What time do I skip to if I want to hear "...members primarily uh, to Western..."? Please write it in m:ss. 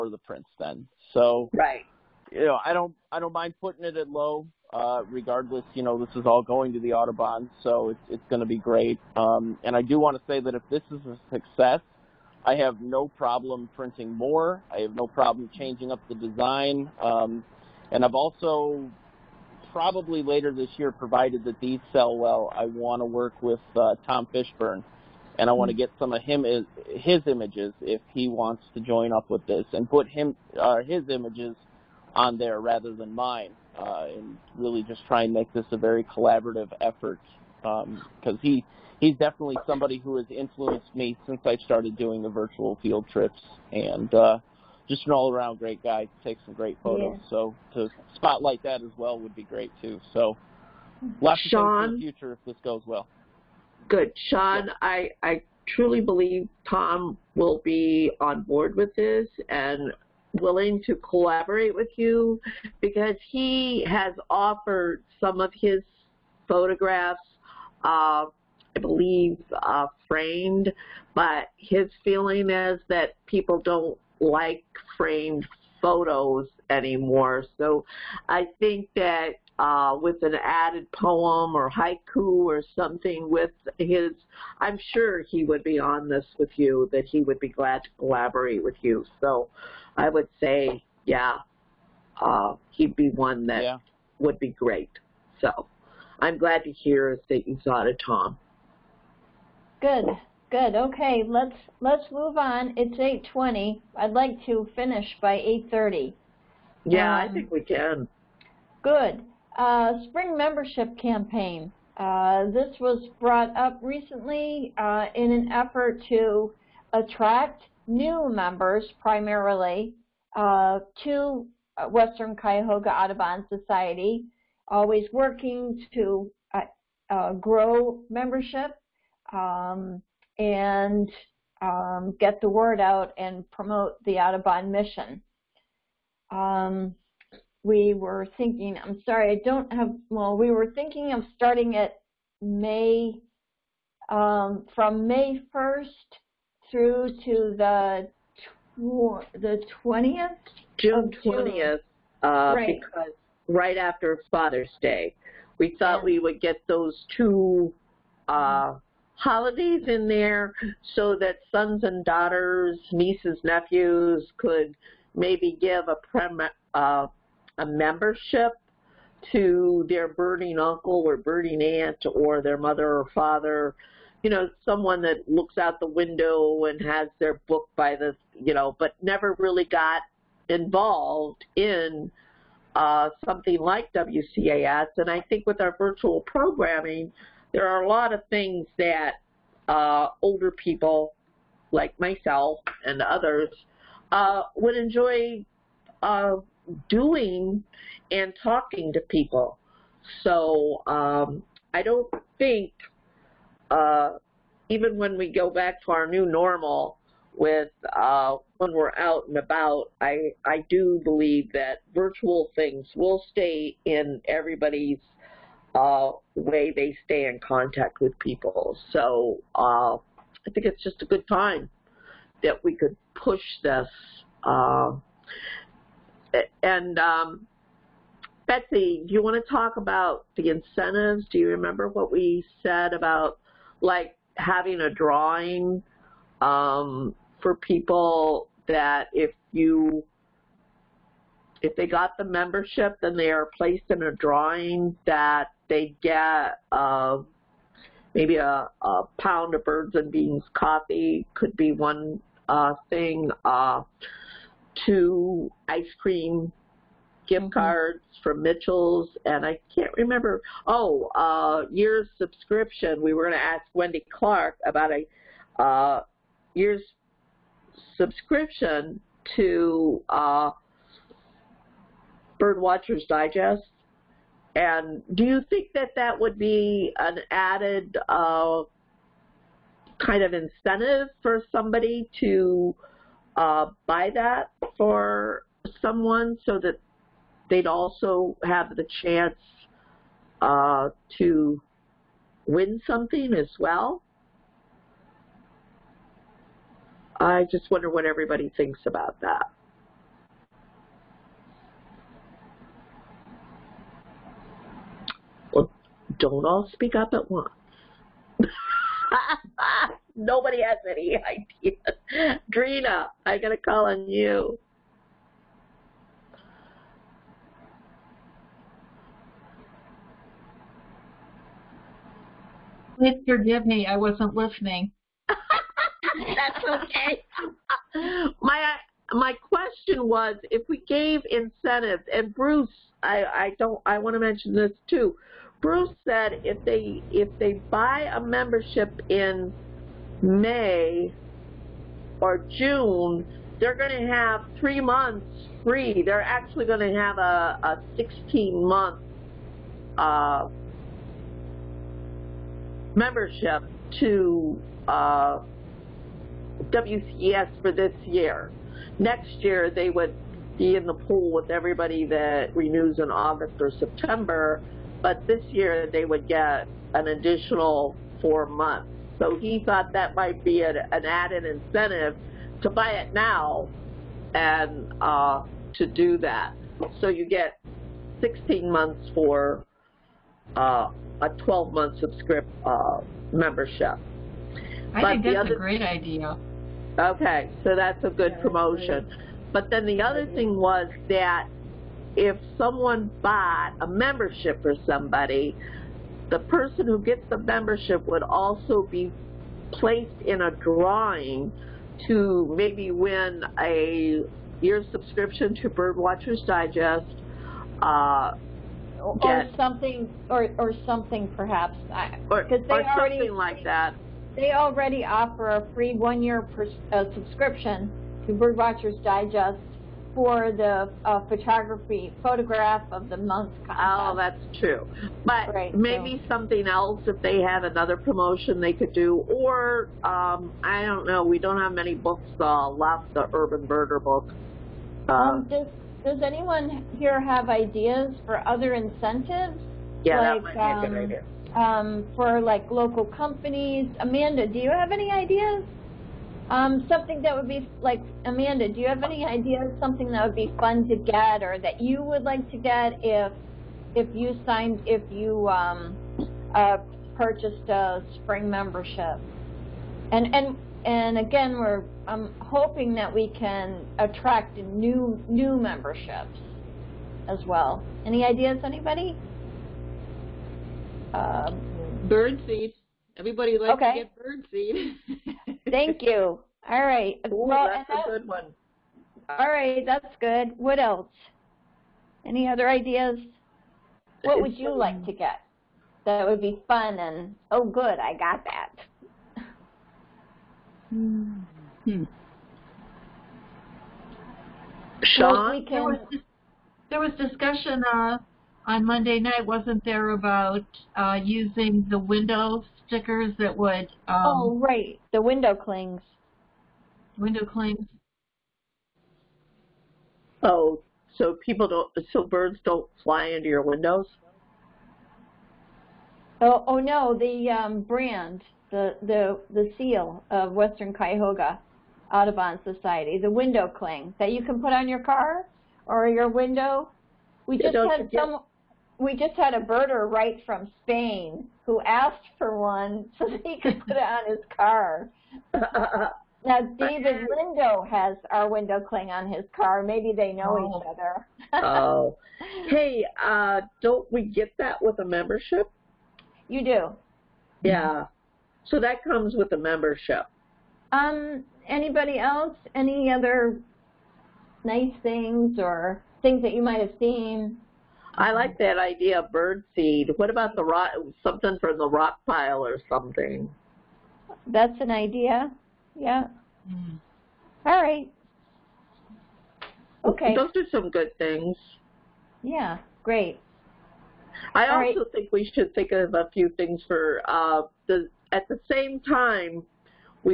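1:58.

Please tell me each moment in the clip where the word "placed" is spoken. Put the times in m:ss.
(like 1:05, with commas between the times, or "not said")
4:03, 6:39.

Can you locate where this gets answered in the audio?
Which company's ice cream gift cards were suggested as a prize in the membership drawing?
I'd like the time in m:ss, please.
4:18.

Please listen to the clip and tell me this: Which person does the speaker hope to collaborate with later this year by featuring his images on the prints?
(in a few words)
Tom Fishburne.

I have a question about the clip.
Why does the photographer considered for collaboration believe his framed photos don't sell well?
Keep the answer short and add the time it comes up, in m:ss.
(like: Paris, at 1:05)
People don't like framed photos, at 1:13.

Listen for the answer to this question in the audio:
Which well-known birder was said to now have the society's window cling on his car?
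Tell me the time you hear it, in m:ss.
8:56.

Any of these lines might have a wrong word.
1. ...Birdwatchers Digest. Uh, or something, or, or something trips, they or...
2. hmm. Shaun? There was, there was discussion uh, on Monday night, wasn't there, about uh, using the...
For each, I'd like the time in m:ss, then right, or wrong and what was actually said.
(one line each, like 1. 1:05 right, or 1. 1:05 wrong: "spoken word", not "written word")
1. 6:45 wrong: "perhaps", not "trips"
2. 8:11 right.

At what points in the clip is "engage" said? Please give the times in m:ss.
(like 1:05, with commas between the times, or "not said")
not said.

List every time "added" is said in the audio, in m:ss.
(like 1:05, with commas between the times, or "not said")
1:20, 4:37, 6:11.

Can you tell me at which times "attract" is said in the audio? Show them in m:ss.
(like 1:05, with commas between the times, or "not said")
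1:56, 7:43.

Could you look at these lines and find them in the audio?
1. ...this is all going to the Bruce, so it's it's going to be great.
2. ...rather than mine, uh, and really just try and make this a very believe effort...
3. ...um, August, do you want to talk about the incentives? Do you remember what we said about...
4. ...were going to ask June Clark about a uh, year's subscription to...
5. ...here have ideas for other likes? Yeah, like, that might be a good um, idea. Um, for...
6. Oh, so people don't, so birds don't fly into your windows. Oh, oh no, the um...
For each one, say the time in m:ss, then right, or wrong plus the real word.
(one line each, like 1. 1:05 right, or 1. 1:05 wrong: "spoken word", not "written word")
1. 0:06 wrong: "Audubon", not "Bruce"
2. 0:32 wrong: "collaborative", not "believe"
3. 3:46 wrong: "Betsy", not "August"
4. 4:23 wrong: "Wendy", not "June"
5. 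7:16 wrong: "incentives", not "likes"
6. 8:30 right.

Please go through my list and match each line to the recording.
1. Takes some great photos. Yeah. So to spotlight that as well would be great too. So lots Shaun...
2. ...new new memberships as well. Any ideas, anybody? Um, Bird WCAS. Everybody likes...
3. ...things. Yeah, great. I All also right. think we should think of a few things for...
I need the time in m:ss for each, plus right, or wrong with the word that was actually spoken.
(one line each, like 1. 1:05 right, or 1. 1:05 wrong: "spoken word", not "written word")
1. 0:46 right
2. 7:44 wrong: "Birdseed", not "WCAS"
3. 9:31 right.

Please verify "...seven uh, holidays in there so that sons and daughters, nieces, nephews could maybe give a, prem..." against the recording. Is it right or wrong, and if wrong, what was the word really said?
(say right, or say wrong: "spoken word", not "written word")
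wrong: "two", not "seven".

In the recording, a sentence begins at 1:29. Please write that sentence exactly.
So I would say, yeah, uh, he'd be one that yeah.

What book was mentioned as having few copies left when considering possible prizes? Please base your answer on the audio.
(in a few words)
The Urban Birder.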